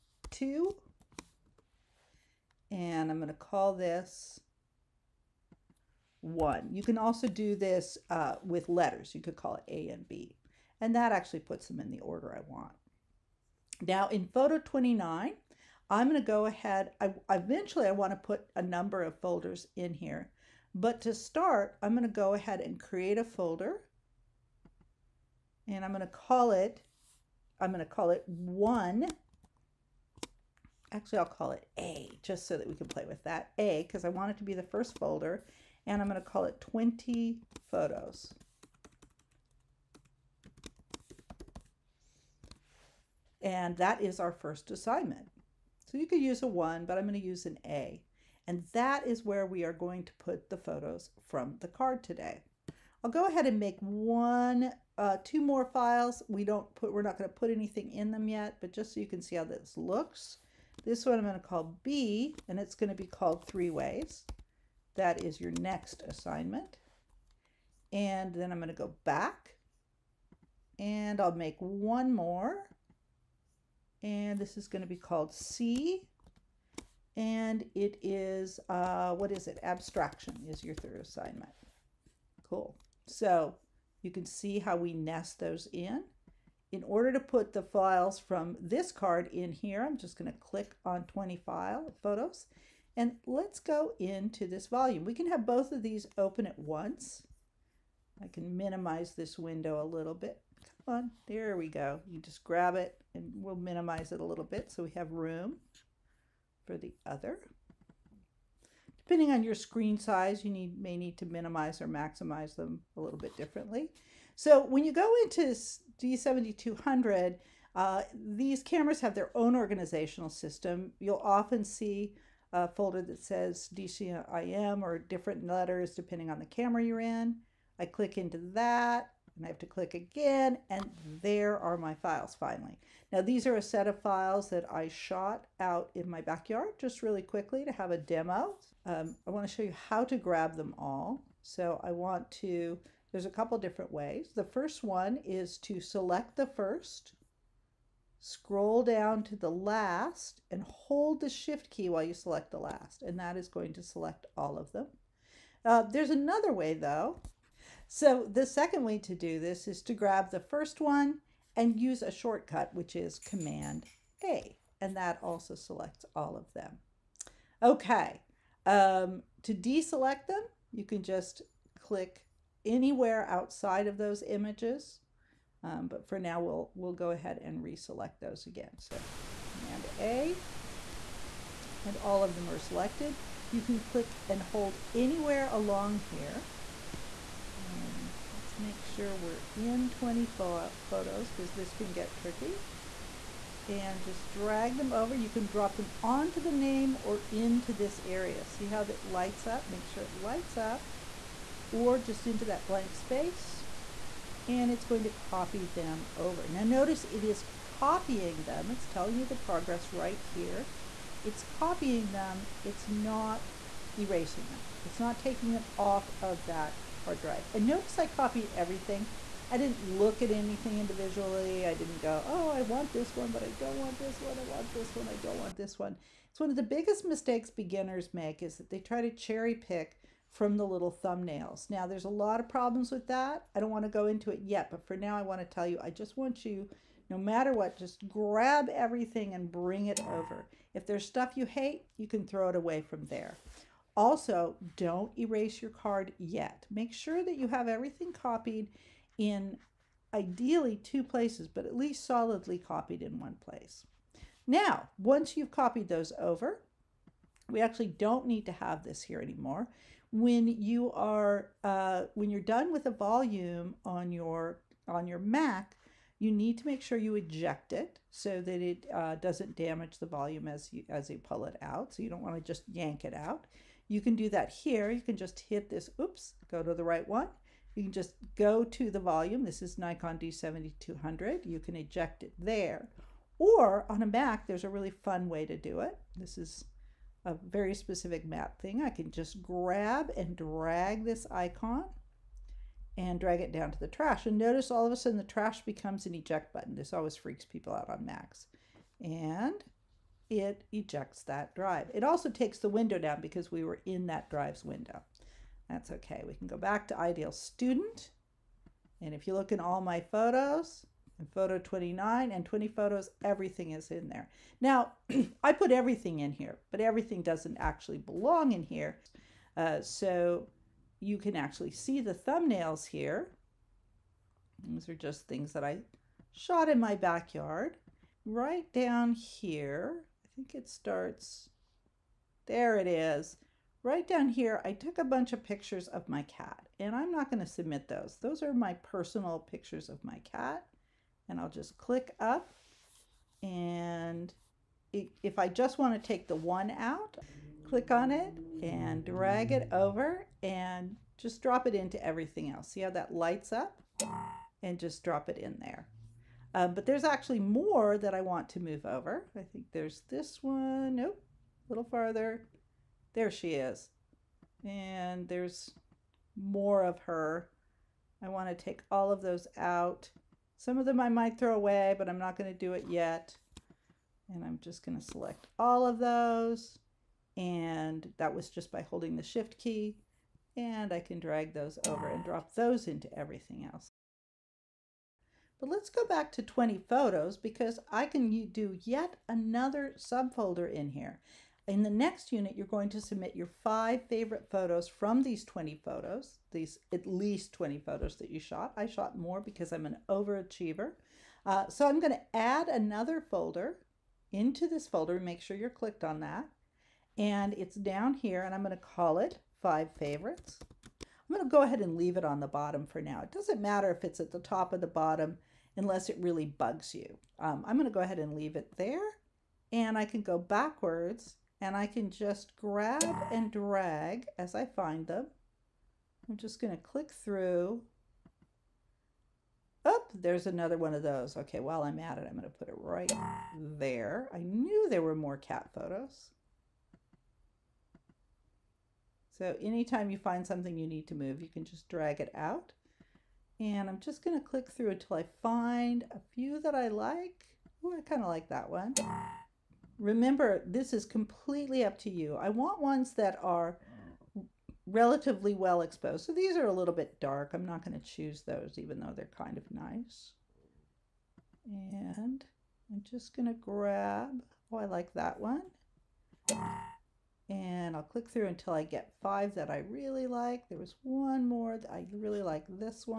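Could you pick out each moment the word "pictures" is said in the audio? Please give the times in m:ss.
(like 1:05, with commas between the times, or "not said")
5:35, 5:39.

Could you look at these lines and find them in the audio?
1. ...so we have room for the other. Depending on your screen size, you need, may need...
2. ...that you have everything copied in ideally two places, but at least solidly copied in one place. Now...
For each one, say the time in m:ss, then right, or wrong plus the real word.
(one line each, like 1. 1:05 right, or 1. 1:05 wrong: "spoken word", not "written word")
1. 1:44 right
2. 4:07 right.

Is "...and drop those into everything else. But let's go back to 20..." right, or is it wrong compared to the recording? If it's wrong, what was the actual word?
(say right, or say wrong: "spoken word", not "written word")
right.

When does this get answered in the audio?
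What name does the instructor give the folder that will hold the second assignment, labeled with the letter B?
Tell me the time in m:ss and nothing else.
1:03.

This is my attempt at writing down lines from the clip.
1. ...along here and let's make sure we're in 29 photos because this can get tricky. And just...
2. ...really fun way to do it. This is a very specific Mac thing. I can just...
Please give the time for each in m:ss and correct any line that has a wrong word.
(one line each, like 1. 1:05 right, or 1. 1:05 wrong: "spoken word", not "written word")
1. 3:05 wrong: "20", not "29"
2. 4:44 right.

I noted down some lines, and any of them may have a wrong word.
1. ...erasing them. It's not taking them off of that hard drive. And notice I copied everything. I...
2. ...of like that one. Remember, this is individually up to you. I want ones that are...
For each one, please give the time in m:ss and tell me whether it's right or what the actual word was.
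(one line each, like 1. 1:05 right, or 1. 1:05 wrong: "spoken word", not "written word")
1. 3:33 right
2. 7:28 wrong: "completely", not "individually".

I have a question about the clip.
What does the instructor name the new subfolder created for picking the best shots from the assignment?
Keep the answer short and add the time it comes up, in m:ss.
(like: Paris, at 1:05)
Five Favorites, at 6:49.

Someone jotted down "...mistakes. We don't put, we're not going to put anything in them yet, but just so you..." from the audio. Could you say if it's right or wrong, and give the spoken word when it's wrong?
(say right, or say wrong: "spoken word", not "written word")
wrong: "files", not "mistakes".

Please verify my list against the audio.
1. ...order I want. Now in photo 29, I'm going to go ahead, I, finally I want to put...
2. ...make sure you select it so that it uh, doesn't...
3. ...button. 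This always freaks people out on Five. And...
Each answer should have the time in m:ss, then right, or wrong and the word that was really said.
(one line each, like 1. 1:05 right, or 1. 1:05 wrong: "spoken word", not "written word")
1. 0:12 wrong: "eventually", not "finally"
2. 4:26 wrong: "eject", not "select"
3. 4:56 wrong: "Macs", not "Five".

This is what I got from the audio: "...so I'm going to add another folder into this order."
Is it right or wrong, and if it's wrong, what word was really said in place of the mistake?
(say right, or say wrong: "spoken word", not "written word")
wrong: "folder", not "order".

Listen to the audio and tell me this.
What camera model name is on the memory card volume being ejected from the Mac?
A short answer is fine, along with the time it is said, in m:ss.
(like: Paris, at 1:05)
Nikon D7200, at 4:39.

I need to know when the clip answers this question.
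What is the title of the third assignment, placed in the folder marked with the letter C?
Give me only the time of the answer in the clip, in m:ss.
1:19.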